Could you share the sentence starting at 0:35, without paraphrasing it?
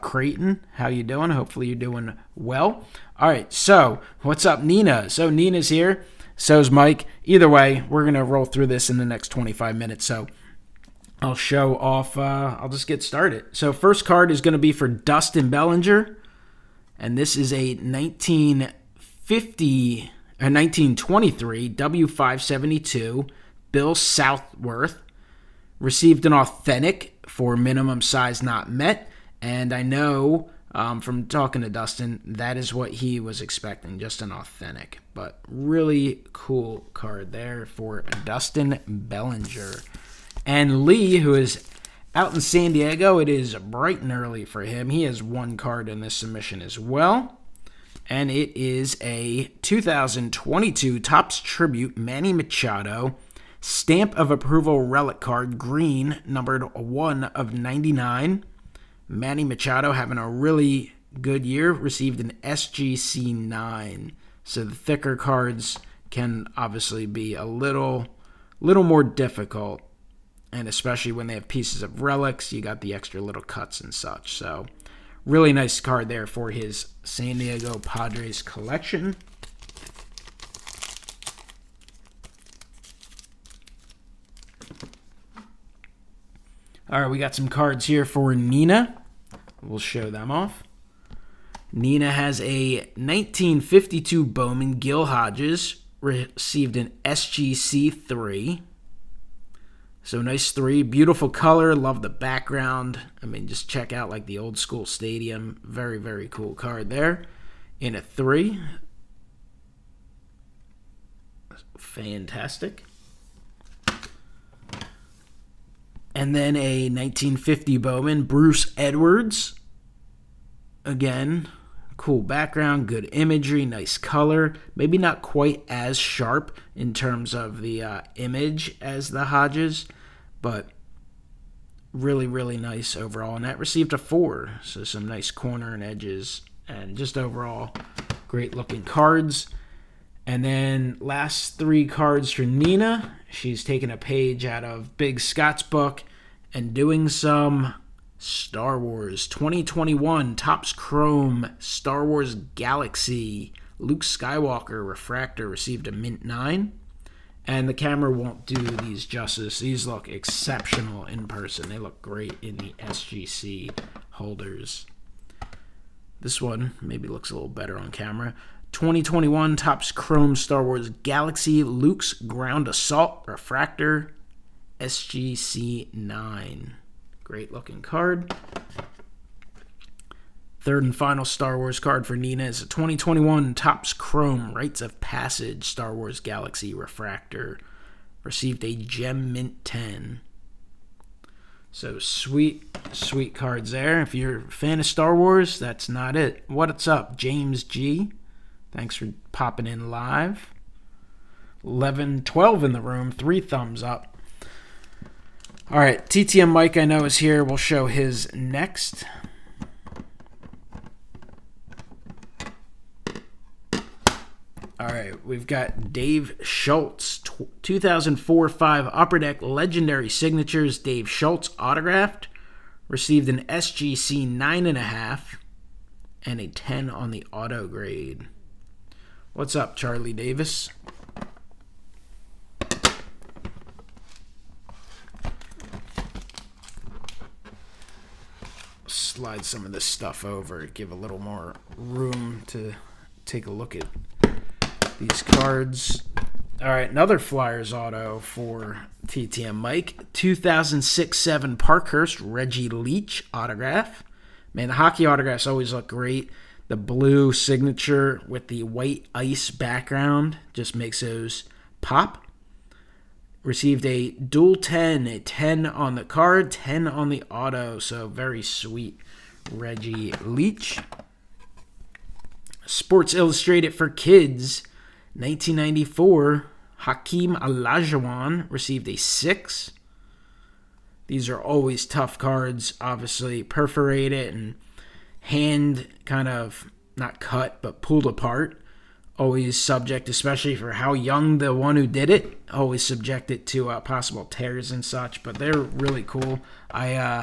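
But really cool card there for Dustin Bellinger.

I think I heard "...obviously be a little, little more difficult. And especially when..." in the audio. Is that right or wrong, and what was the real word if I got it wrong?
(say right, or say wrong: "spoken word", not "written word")
right.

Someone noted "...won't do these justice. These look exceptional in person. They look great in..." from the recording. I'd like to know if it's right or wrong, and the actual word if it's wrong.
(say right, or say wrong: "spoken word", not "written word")
right.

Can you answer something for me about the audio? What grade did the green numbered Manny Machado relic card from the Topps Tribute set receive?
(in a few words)
SGC 9.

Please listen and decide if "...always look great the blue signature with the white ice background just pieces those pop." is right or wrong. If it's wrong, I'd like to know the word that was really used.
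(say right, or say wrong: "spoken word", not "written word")
wrong: "makes", not "pieces".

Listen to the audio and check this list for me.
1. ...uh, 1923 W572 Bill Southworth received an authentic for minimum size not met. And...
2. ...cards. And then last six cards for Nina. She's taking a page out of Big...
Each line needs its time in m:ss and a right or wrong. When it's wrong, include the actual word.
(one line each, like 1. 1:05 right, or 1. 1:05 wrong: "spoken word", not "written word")
1. 0:20 right
2. 2:18 wrong: "three", not "six".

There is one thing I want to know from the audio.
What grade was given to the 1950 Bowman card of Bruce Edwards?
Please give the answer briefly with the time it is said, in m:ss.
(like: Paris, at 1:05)
4, at 2:13.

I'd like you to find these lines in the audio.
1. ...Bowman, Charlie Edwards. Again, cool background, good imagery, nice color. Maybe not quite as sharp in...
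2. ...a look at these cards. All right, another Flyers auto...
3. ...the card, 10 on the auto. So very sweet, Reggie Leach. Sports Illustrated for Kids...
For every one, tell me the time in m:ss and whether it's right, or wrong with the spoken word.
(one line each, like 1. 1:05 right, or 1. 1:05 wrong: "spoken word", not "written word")
1. 1:57 wrong: "Bruce", not "Charlie"
2. 4:03 right
3. 4:25 right.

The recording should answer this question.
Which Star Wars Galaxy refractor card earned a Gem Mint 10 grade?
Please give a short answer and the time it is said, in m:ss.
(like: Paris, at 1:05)
Rites of Passage, at 3:04.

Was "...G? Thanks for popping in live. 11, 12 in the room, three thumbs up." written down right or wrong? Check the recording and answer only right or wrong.
right.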